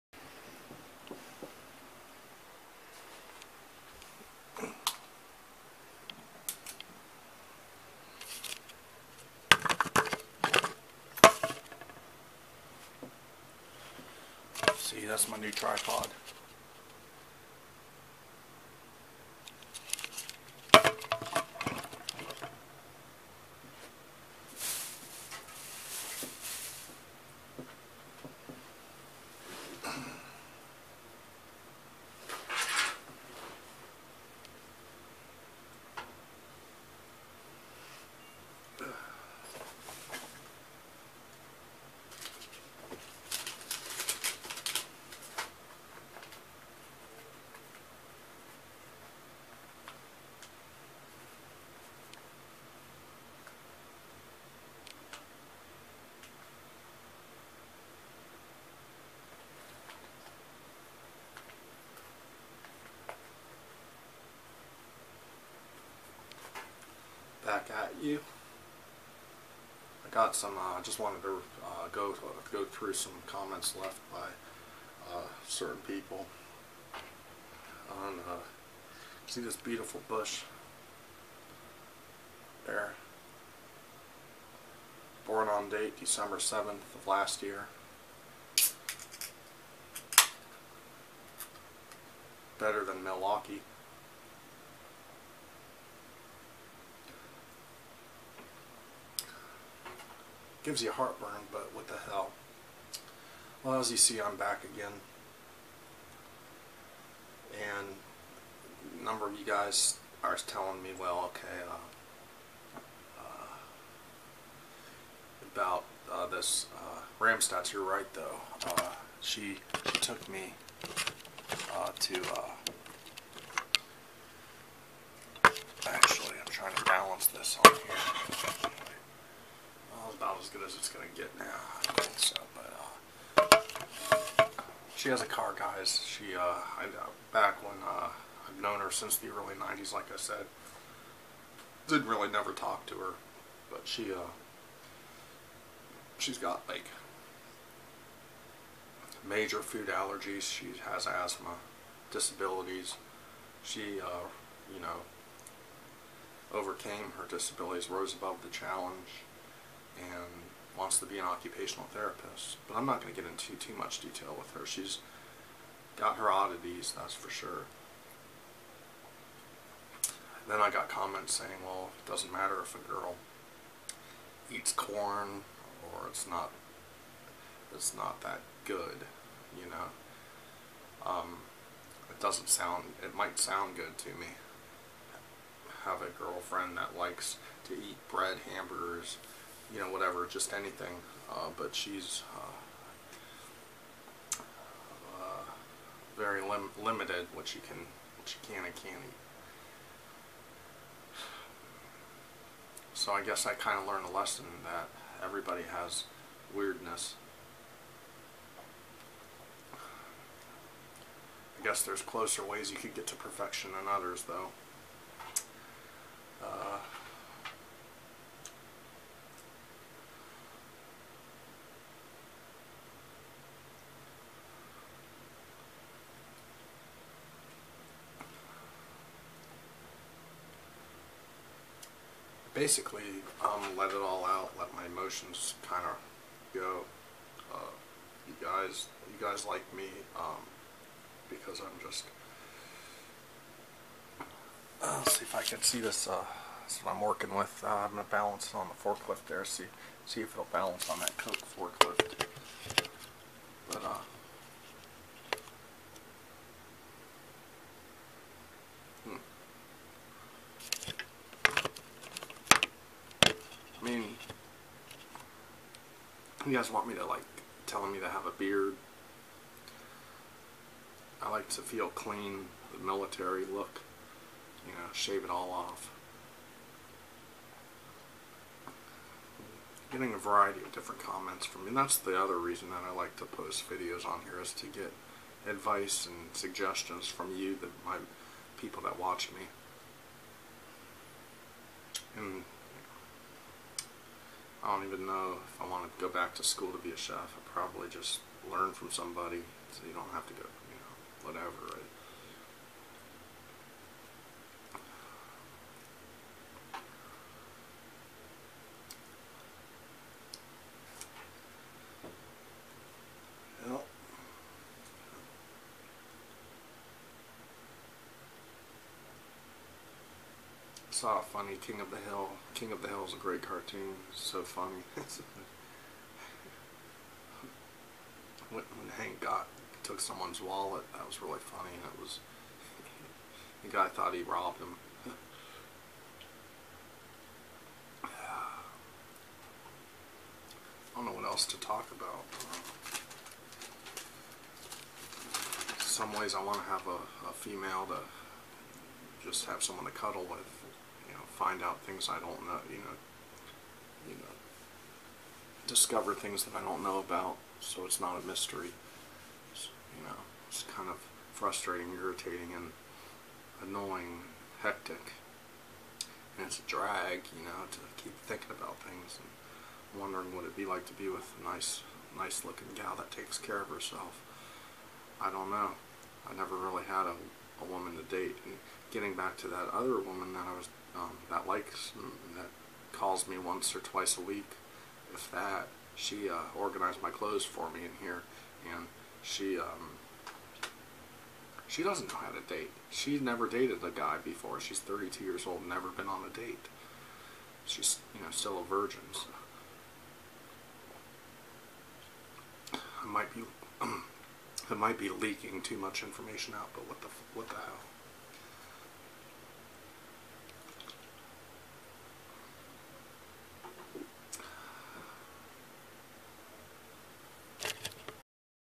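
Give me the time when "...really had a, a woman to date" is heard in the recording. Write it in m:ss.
6:16.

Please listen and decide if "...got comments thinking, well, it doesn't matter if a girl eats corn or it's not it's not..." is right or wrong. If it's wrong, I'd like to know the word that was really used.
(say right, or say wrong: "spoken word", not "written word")
wrong: "saying", not "thinking".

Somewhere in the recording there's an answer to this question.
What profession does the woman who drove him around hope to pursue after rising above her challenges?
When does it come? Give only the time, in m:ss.
2:41.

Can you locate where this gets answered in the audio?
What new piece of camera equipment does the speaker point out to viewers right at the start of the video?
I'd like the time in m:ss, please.
0:15.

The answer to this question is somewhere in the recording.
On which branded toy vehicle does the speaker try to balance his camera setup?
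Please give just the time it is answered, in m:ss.
4:11.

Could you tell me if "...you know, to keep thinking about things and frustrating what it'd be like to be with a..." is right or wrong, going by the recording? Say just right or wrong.
wrong.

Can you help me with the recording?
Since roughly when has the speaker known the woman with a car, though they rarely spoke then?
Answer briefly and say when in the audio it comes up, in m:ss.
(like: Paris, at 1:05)
early 90s, at 2:19.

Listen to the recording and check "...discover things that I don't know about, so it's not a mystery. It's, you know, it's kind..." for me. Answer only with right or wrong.
right.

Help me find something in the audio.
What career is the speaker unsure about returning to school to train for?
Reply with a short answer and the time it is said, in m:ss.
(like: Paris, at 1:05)
chef, at 4:56.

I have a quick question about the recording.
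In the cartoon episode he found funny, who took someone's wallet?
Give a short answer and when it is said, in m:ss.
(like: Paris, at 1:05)
Hank, at 5:28.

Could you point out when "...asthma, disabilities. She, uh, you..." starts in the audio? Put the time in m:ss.
2:31.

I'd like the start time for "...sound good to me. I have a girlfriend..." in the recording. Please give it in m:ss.
3:03.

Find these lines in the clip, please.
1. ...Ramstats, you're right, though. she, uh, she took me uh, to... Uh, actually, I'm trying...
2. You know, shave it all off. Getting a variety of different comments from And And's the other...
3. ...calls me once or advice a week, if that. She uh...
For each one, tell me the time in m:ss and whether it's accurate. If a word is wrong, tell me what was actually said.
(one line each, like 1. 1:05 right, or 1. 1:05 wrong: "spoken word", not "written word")
1. 1:57 right
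2. 4:34 wrong: "That", not "And"
3. 6:22 wrong: "twice", not "advice".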